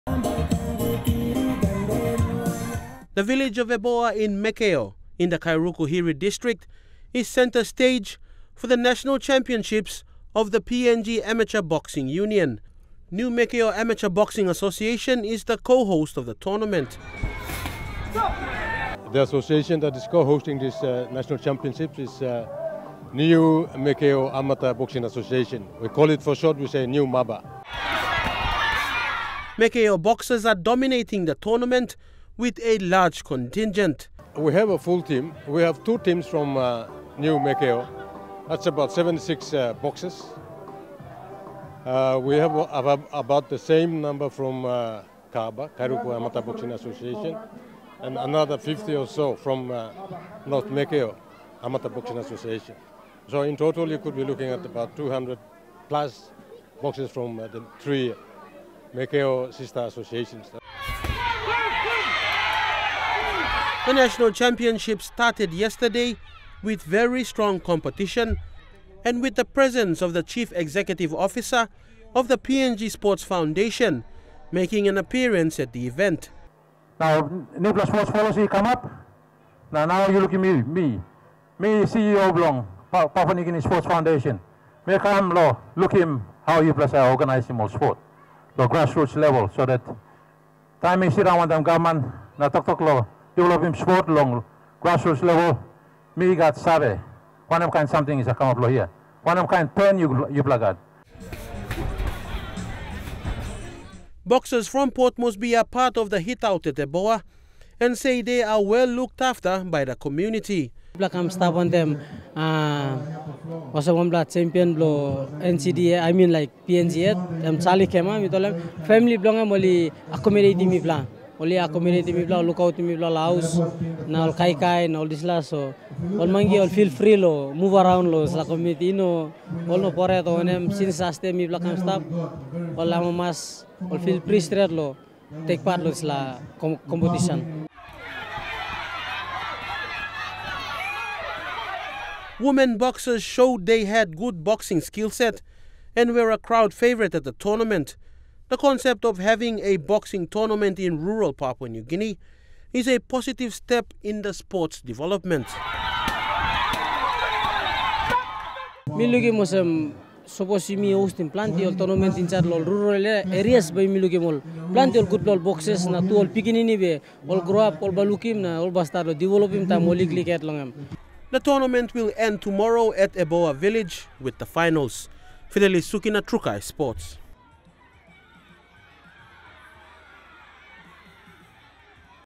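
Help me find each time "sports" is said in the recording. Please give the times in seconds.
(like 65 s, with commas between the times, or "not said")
72 s, 77 s, 83 s, 87 s, 93 s, 154 s, 176 s.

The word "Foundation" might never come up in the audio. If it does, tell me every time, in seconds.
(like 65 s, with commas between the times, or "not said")
73 s, 83 s.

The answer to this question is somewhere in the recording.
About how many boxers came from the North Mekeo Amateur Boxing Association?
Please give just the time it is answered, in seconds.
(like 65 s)
48 s.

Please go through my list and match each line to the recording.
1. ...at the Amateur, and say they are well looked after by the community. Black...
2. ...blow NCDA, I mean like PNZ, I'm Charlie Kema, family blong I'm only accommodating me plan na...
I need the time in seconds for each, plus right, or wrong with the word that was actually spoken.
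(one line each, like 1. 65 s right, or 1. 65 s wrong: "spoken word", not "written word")
1. 106 s wrong: "Eboa", not "Amateur"
2. 114 s right.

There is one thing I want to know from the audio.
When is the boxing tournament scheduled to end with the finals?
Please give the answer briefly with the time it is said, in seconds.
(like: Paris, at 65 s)
tomorrow, at 172 s.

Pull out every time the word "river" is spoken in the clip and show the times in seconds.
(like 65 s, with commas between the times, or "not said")
not said.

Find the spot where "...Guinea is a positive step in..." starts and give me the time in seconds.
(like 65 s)
151 s.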